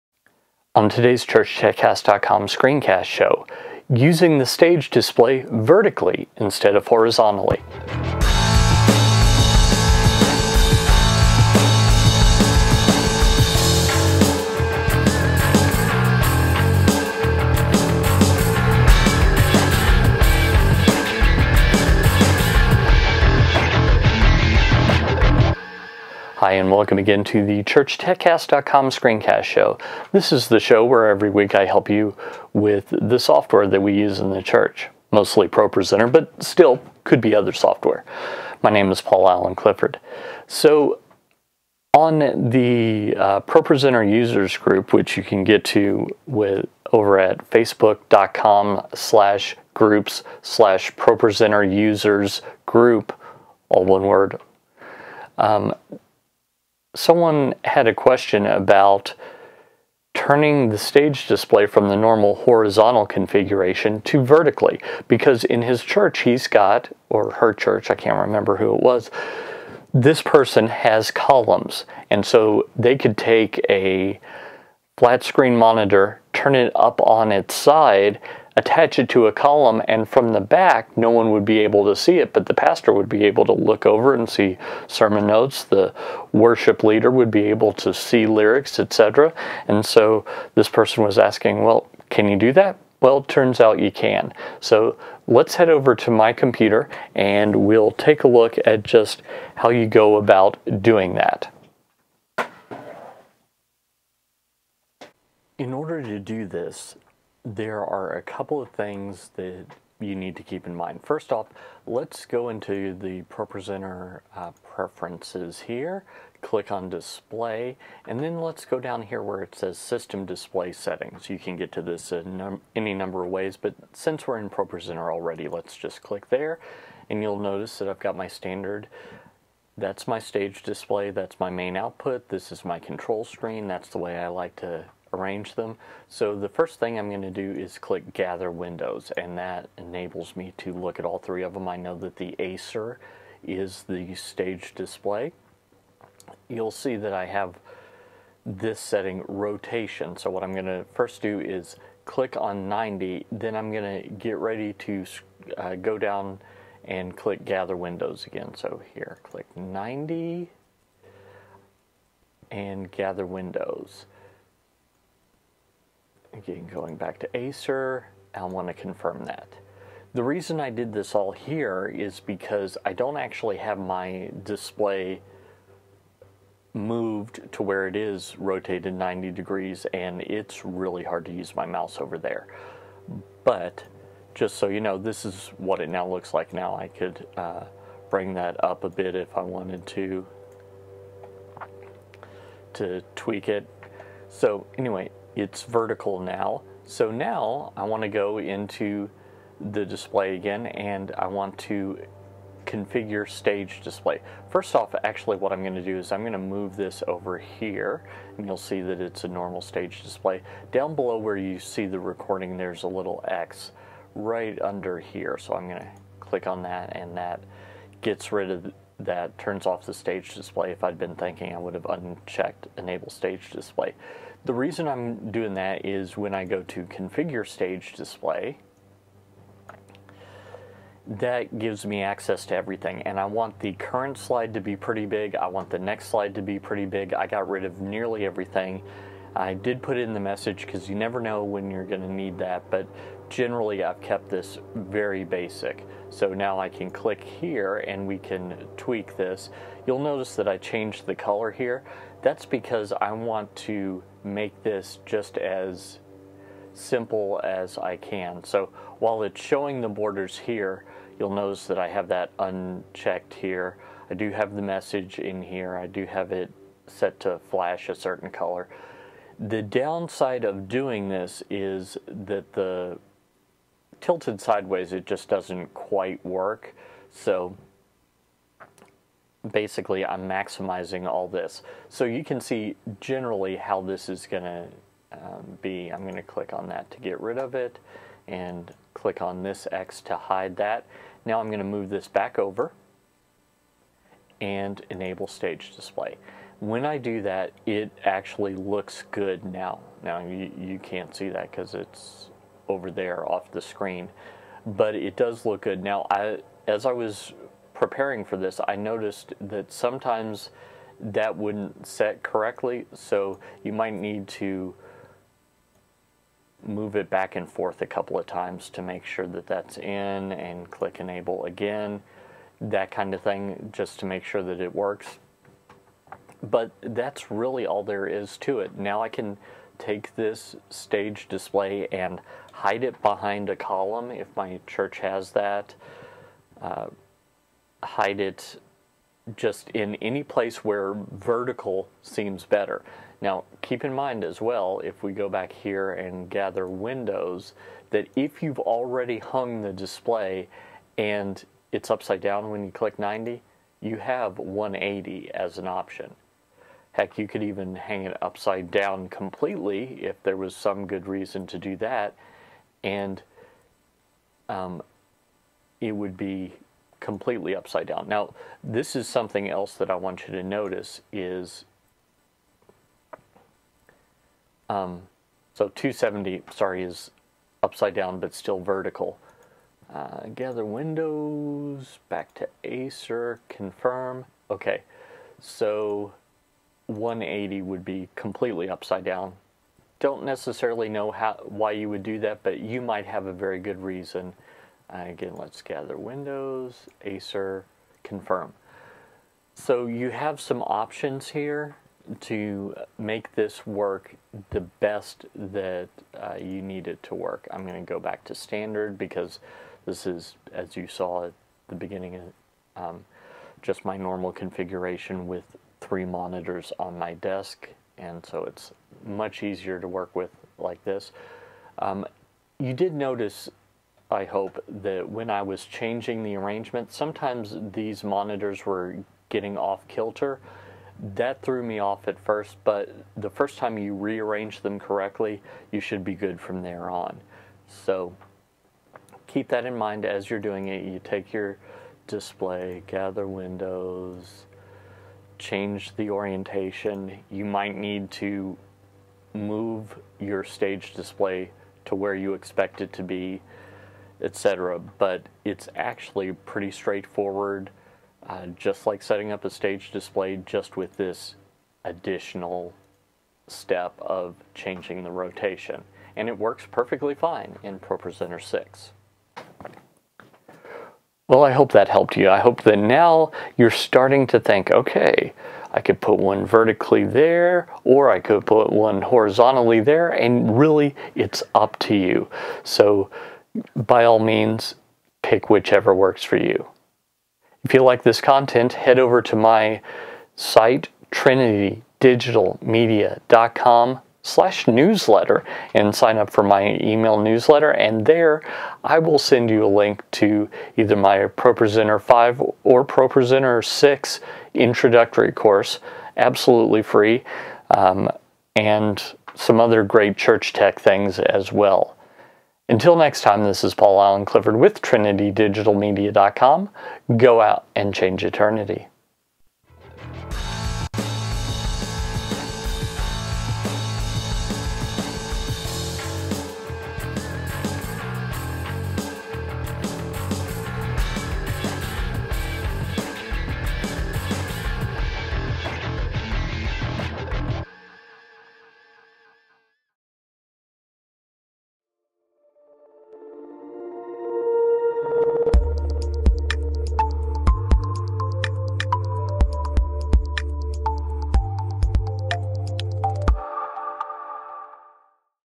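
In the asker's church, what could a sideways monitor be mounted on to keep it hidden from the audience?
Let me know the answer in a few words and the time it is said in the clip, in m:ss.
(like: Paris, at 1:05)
Columns, at 1:11.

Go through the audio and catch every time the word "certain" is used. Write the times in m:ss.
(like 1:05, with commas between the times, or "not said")
4:27.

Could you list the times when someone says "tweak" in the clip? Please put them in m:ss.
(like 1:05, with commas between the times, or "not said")
3:13, 4:08.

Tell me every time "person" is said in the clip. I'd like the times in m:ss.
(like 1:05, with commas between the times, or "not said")
1:10, 1:30.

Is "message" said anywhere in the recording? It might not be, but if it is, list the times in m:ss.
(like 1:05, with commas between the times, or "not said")
4:00, 4:24.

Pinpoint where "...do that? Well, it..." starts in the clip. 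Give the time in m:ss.
1:32.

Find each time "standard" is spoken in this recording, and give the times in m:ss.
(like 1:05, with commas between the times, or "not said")
2:08, 6:48.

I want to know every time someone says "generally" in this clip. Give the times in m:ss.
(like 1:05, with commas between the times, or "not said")
4:03, 4:42.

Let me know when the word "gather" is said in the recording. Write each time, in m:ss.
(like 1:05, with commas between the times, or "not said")
2:18, 2:37, 2:42, 5:46, 6:20, 6:35, 7:22.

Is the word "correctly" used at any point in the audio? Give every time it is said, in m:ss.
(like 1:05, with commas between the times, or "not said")
5:12, 7:14.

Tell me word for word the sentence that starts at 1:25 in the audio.
The worship leader would be able to see lyrics, etc.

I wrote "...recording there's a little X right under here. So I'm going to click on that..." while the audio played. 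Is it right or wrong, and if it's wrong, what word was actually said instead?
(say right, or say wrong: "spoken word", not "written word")
right.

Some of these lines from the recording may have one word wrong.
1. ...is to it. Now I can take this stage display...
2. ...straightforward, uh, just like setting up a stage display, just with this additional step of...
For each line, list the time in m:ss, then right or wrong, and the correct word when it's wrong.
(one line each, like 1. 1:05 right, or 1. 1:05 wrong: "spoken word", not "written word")
1. 5:28 right
2. 7:36 right.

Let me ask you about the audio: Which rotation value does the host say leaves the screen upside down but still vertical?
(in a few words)
270.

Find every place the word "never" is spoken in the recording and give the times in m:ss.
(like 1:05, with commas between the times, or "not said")
4:00.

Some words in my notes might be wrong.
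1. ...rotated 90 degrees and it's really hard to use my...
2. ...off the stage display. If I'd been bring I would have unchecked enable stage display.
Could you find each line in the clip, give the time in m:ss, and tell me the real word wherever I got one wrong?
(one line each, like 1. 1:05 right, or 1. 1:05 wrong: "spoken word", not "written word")
1. 2:58 right
2. 3:39 wrong: "thinking", not "bring".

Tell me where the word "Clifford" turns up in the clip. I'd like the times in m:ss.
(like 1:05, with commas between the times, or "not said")
0:39, 8:34.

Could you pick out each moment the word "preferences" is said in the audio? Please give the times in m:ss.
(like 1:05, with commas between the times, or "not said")
1:54.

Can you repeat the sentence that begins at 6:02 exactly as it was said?
And um, it would be completely upside down.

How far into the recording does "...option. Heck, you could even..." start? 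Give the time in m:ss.
5:55.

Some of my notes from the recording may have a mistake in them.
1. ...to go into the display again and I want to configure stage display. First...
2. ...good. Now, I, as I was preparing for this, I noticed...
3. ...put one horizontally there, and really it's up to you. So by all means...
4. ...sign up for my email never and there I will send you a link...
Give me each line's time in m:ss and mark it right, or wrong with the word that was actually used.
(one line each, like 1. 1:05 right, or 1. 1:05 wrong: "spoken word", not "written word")
1. 3:18 right
2. 5:05 right
3. 7:58 right
4. 8:15 wrong: "newsletter", not "never".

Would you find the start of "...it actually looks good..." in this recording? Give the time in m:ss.
4:57.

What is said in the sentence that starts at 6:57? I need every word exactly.
And so it's much easier to work with like this.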